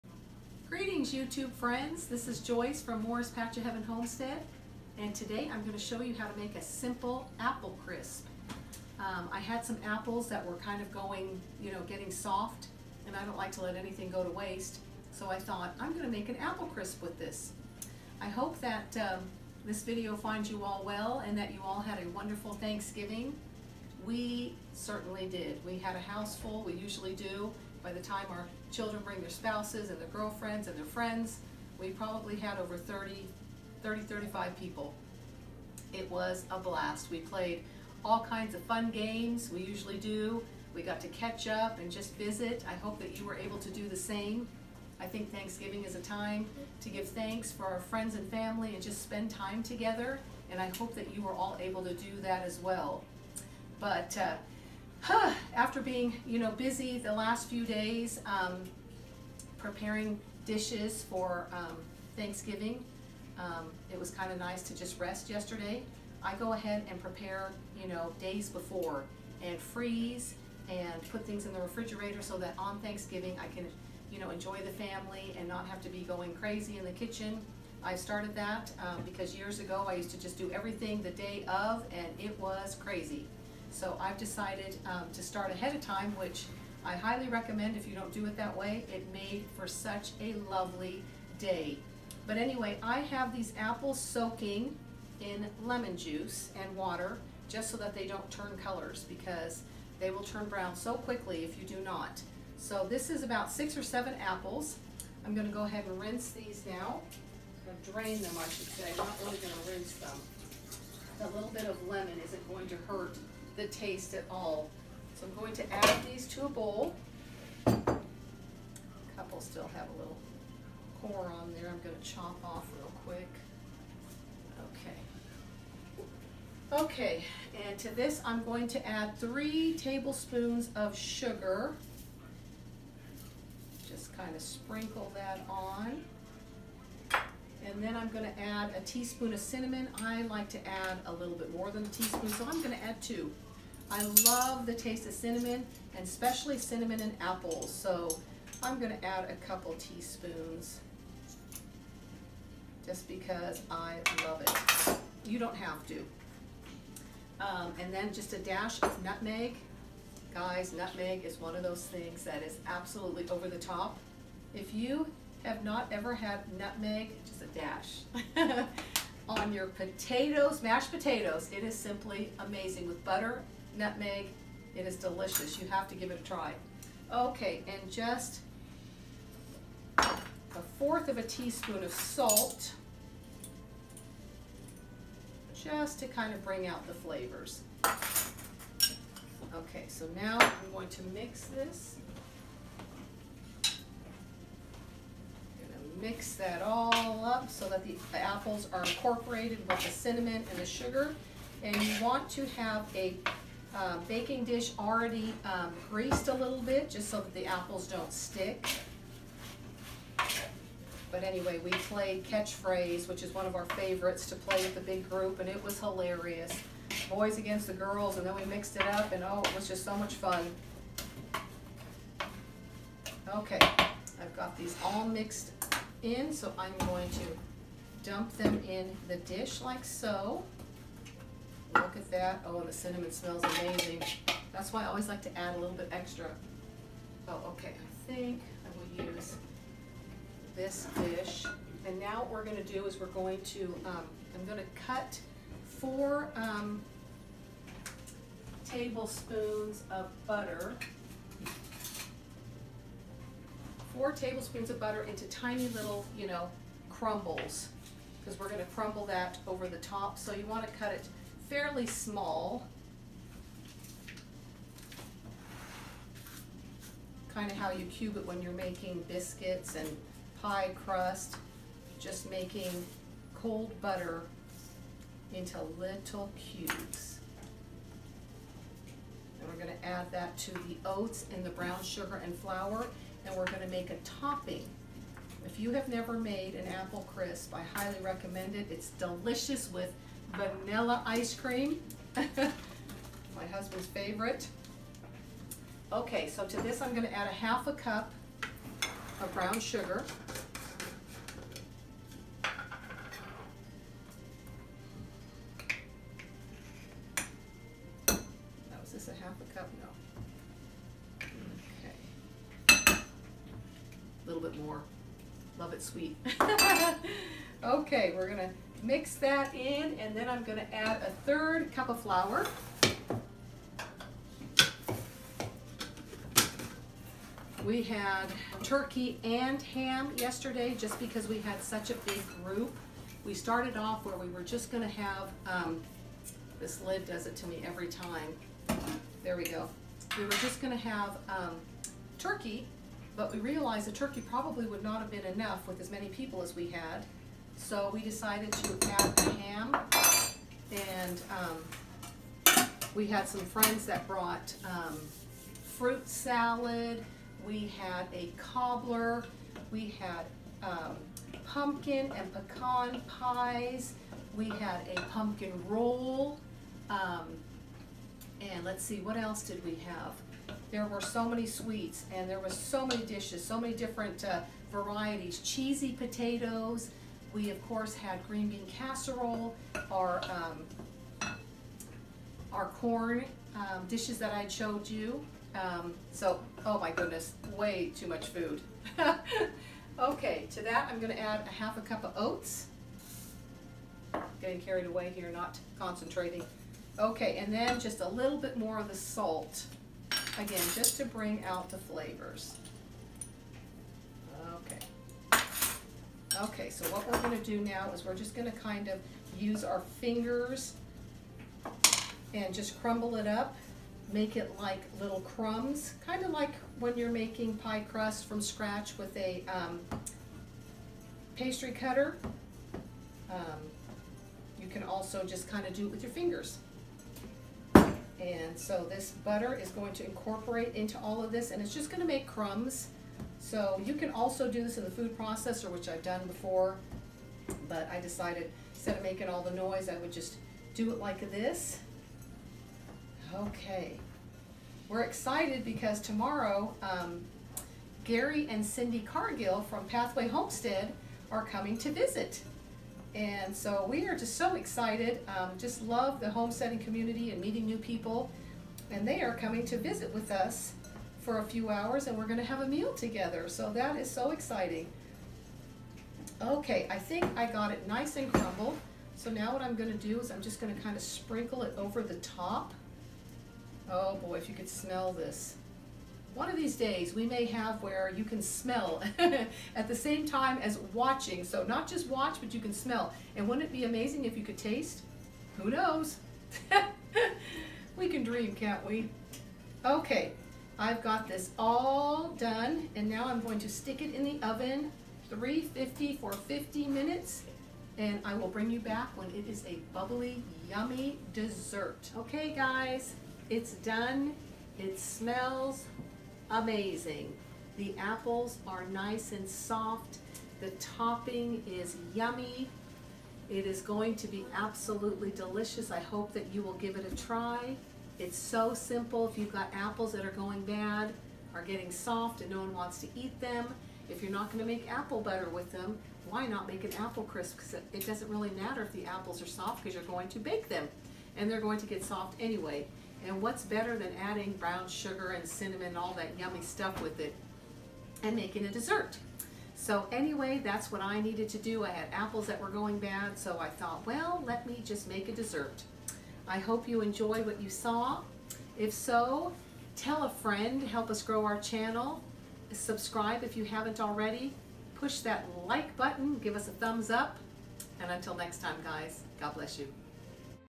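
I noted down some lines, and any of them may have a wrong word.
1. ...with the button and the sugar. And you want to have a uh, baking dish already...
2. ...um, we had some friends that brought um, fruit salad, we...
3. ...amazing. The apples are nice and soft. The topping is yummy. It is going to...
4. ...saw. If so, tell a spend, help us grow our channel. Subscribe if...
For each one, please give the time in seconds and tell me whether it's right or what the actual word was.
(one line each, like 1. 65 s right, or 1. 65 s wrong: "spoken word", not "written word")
1. 199 s wrong: "cinnamon", not "button"
2. 351 s right
3. 506 s right
4. 547 s wrong: "friend", not "spend".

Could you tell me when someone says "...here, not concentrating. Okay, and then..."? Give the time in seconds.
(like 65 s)
395 s.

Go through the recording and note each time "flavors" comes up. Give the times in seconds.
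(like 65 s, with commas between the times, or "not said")
186 s, 401 s.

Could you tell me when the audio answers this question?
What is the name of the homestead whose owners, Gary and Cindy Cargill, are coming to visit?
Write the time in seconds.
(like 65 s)
449 s.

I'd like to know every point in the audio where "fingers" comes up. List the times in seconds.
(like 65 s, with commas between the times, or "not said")
409 s, 426 s.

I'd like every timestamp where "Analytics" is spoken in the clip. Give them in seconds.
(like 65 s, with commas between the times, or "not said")
not said.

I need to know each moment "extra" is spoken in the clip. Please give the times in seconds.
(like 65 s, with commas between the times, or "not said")
235 s.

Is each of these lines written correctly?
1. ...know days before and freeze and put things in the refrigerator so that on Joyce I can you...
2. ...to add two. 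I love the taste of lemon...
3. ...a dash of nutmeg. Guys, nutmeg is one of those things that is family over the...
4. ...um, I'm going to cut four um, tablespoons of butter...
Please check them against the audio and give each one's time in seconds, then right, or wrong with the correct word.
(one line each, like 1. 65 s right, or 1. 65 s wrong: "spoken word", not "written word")
1. 67 s wrong: "Thanksgiving", not "Joyce"
2. 142 s wrong: "cinnamon", not "lemon"
3. 158 s wrong: "absolutely", not "family"
4. 243 s right.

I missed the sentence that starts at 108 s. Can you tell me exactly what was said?
I'm not really going to rinse them.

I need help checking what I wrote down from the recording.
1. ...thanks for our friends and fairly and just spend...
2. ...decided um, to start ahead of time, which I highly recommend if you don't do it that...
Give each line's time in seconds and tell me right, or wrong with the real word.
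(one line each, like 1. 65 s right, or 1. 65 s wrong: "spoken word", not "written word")
1. 47 s wrong: "family", not "fairly"
2. 84 s right.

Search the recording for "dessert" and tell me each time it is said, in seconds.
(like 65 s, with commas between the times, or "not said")
501 s, 538 s, 545 s.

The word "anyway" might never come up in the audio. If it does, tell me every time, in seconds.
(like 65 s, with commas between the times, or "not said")
92 s, 211 s, 532 s, 540 s.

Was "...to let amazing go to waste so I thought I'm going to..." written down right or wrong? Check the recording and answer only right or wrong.
wrong.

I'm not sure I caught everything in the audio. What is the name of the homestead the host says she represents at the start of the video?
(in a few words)
Morris Patch of Heaven Homestead.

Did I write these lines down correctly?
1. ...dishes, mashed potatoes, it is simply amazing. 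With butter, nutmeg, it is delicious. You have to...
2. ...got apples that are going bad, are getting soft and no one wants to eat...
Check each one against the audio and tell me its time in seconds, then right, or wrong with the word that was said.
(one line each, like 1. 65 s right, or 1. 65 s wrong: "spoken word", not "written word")
1. 169 s wrong: "potatoes", not "dishes"
2. 519 s right.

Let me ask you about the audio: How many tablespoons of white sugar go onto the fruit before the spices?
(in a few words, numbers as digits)
3.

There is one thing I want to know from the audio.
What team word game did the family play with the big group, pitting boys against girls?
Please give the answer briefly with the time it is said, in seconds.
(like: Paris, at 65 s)
Catchphrase, at 212 s.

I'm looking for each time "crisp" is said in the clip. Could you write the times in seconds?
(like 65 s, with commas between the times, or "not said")
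7 s, 16 s, 287 s, 527 s.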